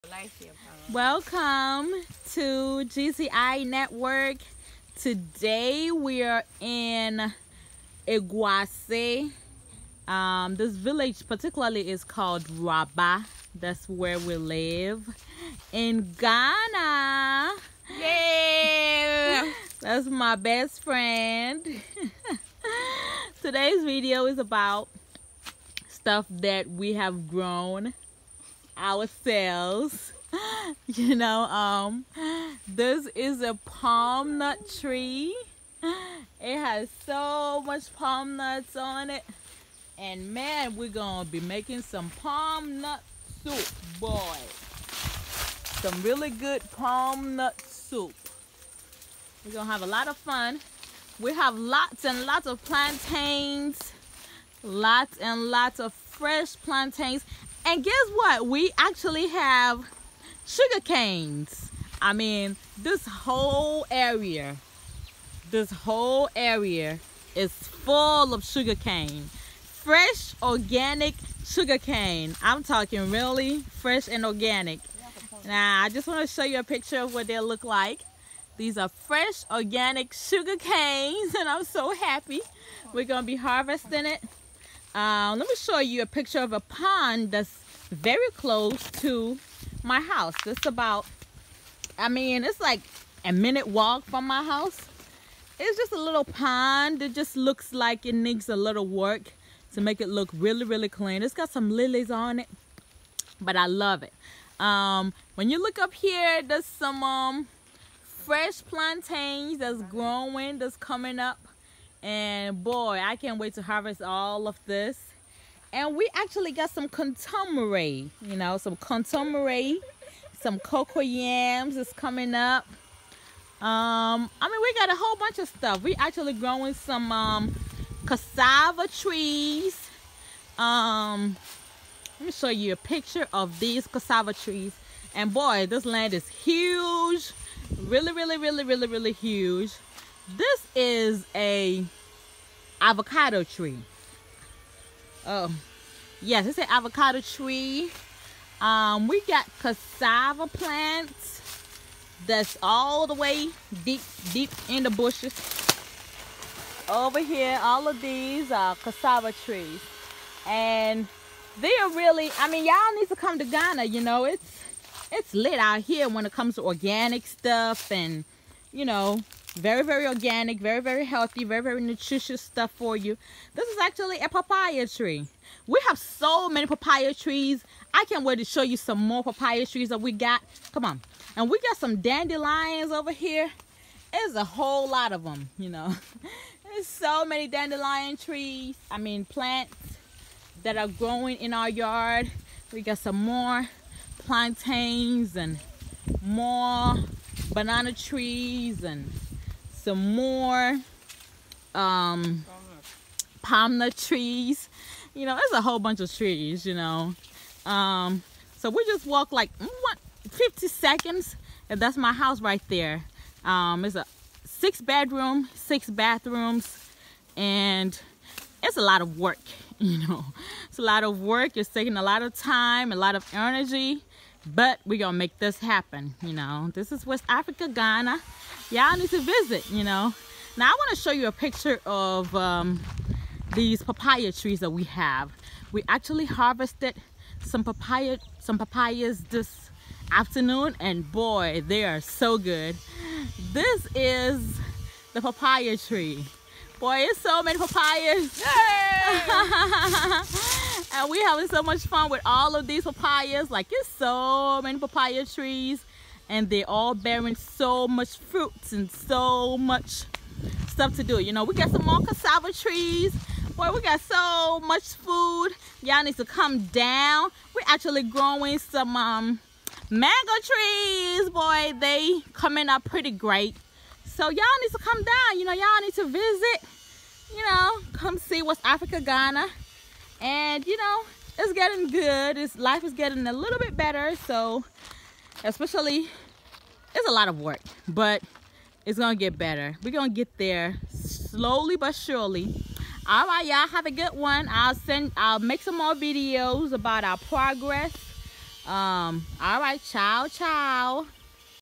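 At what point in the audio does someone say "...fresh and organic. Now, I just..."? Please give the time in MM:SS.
01:13.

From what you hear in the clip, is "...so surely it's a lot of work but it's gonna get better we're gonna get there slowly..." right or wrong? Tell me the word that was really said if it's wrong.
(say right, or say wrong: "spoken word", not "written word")
wrong: "especially", not "surely".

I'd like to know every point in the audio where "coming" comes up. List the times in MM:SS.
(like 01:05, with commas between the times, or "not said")
01:50, 02:01, 04:32.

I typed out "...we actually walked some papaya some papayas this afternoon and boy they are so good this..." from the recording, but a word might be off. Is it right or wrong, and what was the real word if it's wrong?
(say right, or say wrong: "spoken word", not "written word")
wrong: "harvested", not "walked".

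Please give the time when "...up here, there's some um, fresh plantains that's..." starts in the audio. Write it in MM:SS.
01:45.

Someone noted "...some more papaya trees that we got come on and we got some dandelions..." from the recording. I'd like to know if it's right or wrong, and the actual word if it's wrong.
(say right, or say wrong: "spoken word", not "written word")
right.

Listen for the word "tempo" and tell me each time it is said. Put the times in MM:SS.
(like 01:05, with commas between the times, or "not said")
not said.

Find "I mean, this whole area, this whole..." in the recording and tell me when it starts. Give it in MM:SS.
01:02.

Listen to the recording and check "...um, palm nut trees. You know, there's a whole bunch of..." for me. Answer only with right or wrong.
right.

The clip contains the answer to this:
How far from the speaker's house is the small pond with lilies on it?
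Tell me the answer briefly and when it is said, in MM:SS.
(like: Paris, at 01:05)
a minute walk, at 01:33.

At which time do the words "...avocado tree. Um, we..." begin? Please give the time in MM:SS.
02:26.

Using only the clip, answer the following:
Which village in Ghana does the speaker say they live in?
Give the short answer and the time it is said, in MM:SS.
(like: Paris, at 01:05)
Raba, at 00:12.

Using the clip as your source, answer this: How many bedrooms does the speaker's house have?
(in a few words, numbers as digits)
6.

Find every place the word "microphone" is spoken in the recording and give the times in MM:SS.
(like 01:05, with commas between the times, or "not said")
not said.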